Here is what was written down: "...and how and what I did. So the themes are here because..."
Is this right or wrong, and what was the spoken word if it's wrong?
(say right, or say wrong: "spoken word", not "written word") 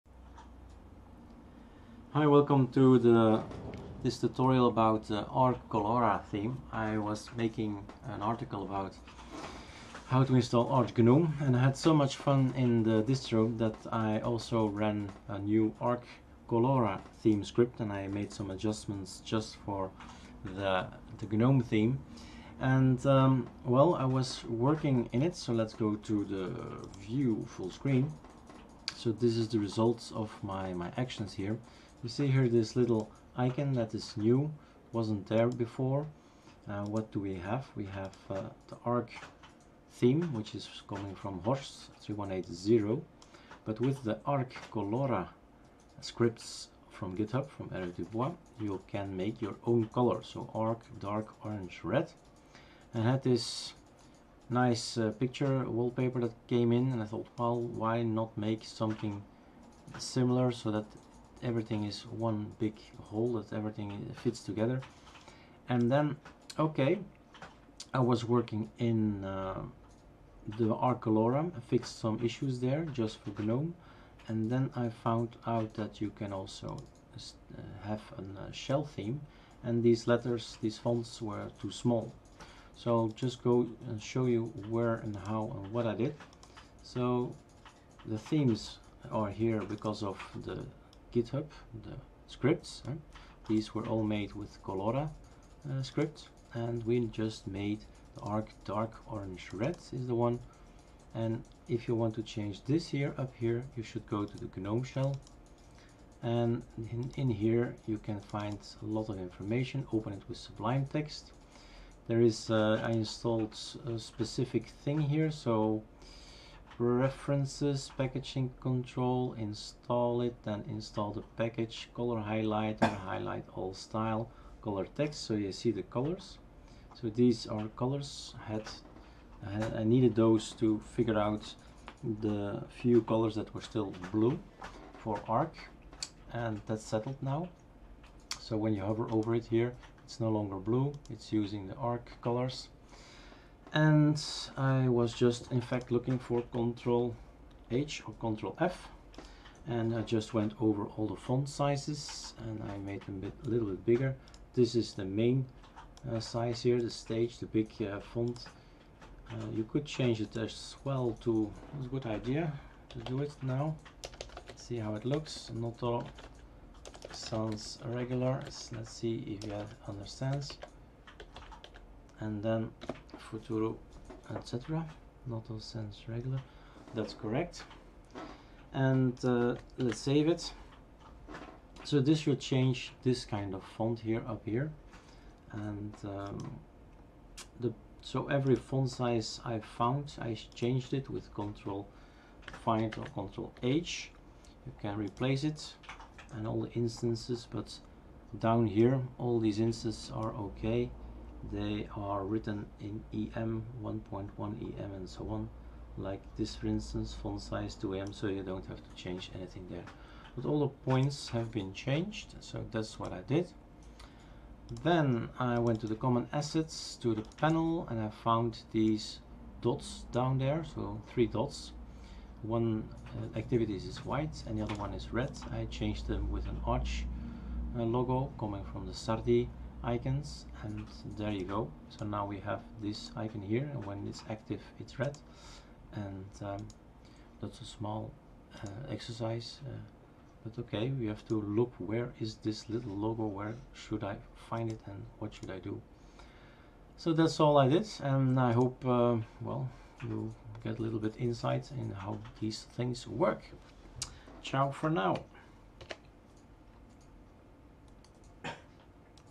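right.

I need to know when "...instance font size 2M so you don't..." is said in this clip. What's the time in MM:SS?
03:26.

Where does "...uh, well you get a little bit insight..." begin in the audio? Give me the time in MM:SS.
04:08.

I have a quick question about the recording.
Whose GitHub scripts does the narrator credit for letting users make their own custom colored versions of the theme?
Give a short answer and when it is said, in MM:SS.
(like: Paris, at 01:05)
Erik Dubois, at 00:47.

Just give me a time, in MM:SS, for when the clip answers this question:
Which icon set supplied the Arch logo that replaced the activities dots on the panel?
03:48.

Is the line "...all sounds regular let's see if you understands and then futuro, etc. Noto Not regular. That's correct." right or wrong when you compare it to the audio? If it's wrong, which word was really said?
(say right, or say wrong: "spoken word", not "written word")
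wrong: "Sans", not "Not".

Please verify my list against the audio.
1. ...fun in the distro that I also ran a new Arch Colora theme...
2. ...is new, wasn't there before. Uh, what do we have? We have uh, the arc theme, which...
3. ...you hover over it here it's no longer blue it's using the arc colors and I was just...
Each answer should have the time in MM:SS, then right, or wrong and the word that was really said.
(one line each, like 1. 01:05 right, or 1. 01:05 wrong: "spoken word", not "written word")
1. 00:12 right
2. 00:33 right
3. 02:18 right.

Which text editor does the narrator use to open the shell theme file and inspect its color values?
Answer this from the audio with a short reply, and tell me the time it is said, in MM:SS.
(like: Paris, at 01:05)
Sublime Text, at 01:50.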